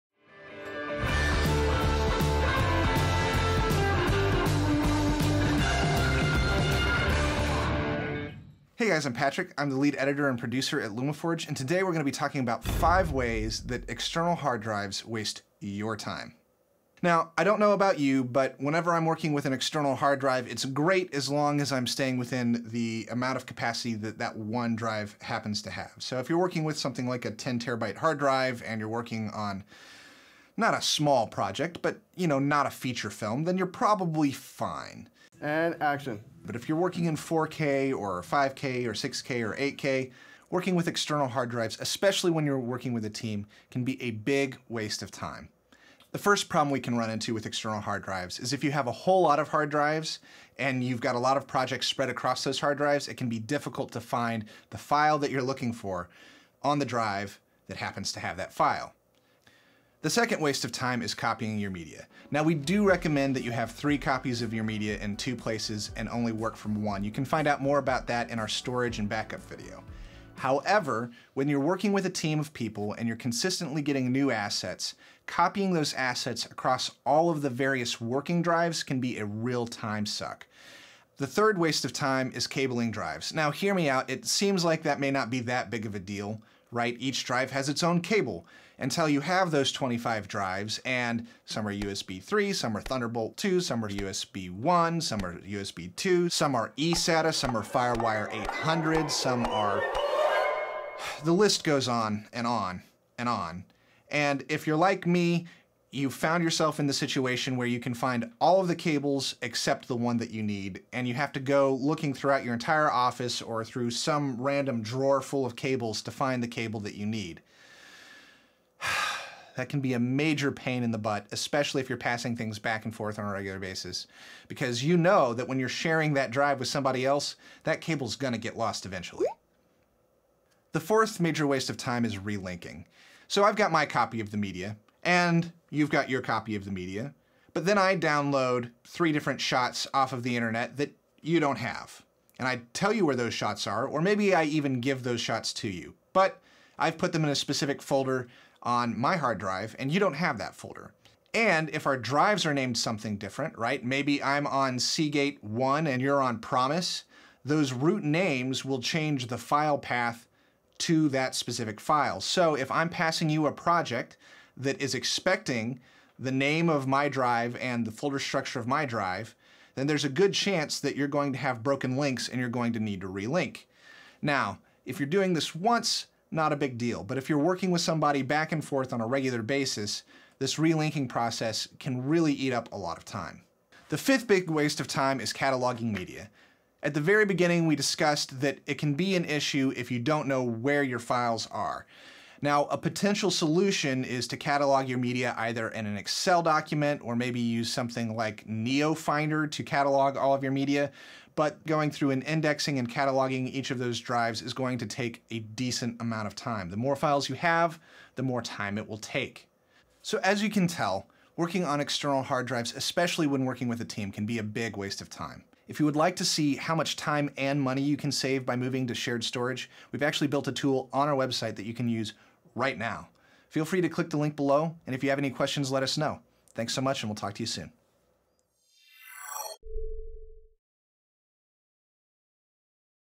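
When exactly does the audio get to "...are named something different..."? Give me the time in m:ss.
2:32.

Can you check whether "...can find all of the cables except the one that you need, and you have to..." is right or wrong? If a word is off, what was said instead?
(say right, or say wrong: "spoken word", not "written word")
right.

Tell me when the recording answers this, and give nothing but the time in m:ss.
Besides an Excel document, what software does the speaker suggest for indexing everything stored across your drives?
3:18.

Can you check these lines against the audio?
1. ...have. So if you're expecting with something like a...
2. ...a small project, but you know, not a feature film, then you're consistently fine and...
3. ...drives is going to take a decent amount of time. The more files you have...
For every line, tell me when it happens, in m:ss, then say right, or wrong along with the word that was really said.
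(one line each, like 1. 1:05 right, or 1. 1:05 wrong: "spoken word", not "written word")
1. 0:25 wrong: "working", not "expecting"
2. 0:30 wrong: "probably", not "consistently"
3. 3:23 right.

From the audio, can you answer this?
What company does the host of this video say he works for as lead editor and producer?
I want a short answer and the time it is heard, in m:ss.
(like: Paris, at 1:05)
LumaForge, at 0:10.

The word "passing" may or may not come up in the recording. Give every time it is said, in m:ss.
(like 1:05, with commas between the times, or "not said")
2:01, 2:42.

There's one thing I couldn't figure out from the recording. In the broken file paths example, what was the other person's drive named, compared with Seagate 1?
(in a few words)
Promise.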